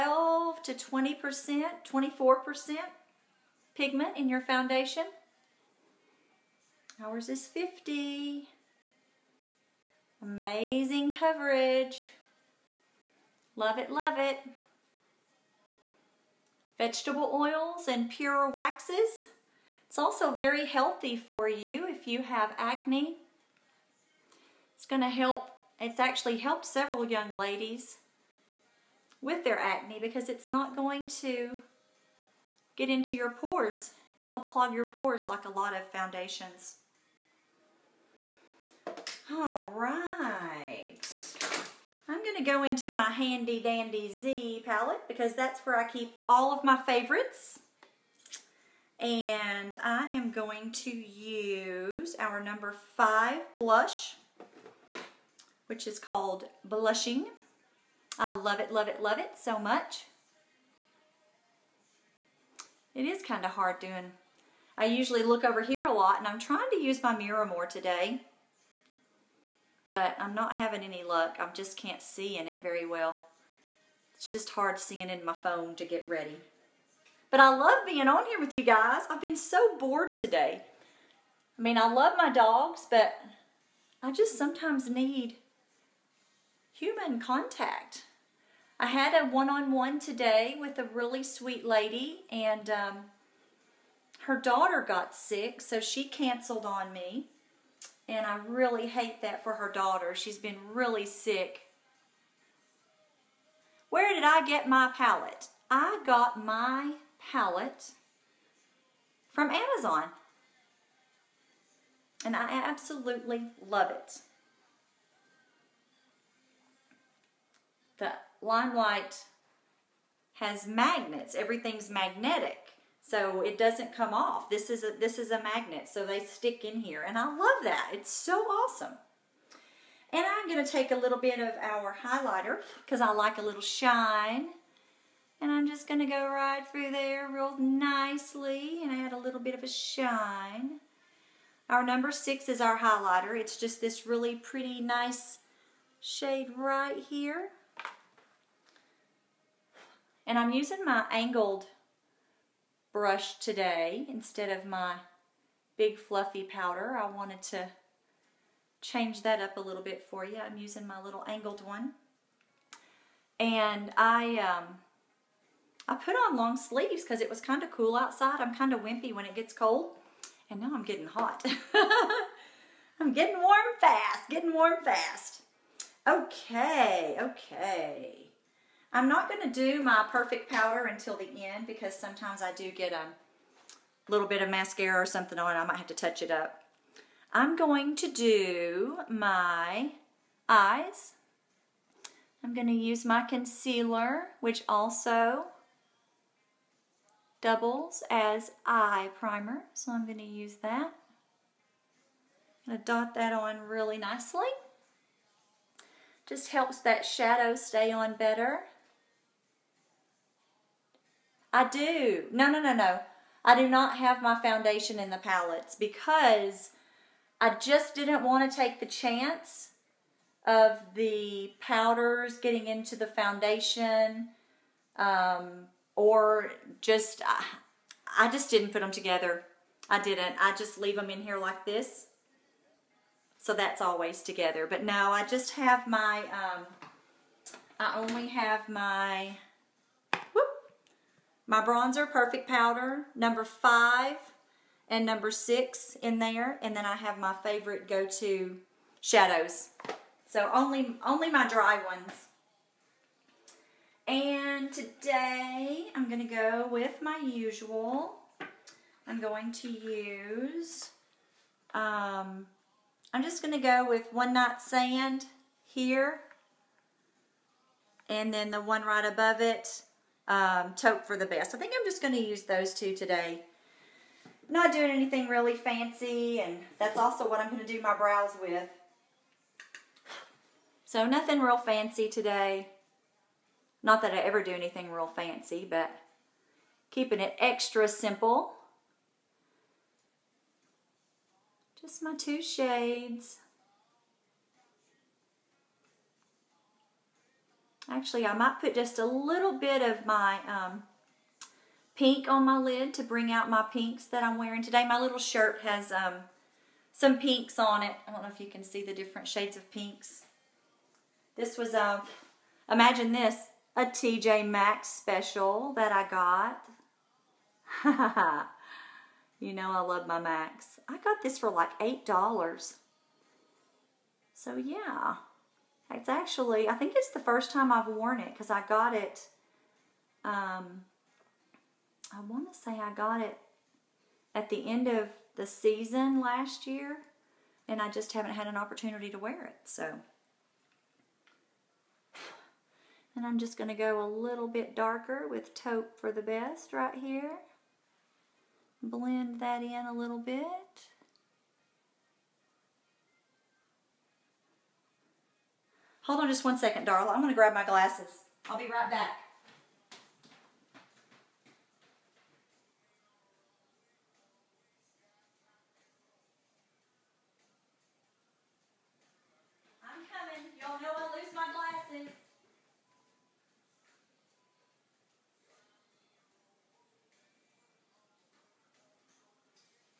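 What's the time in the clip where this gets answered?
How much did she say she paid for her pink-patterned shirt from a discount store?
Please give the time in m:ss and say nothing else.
5:21.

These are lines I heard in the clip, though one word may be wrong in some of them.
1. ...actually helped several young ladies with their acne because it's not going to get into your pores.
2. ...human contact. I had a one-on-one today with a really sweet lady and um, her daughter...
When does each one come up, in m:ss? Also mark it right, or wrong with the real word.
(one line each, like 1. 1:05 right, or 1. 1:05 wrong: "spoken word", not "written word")
1. 0:25 right
2. 1:26 right.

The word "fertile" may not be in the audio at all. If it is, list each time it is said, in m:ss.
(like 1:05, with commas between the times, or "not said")
not said.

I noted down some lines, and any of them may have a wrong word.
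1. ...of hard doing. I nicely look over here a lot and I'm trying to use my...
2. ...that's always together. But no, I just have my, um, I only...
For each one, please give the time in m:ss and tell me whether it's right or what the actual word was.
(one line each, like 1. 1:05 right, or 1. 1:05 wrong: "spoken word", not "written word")
1. 1:03 wrong: "usually", not "nicely"
2. 3:53 right.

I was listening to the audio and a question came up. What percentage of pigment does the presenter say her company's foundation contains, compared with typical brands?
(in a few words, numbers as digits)
50.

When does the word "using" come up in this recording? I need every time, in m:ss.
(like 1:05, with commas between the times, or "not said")
2:30, 2:40.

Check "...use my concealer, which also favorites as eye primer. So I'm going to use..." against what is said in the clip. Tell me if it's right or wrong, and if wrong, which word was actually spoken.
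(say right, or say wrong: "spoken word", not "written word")
wrong: "doubles", not "favorites".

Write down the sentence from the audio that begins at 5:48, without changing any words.
Blend that in a little bit.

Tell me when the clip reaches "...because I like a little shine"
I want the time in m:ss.
2:12.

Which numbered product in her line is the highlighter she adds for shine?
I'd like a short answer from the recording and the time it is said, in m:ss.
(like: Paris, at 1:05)
6, at 2:21.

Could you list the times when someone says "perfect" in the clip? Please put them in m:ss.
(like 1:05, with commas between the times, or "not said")
3:00, 4:02.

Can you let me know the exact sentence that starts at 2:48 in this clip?
I'm kind of wimpy when it gets cold.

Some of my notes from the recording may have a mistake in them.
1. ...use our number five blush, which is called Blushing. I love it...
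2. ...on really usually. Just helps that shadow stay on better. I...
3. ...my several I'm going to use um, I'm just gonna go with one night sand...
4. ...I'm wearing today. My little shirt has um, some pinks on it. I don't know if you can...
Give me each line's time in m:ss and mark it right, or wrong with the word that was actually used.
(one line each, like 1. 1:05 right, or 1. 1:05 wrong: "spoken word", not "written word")
1. 0:50 right
2. 3:23 wrong: "nicely", not "usually"
3. 4:17 wrong: "usual", not "several"
4. 5:04 right.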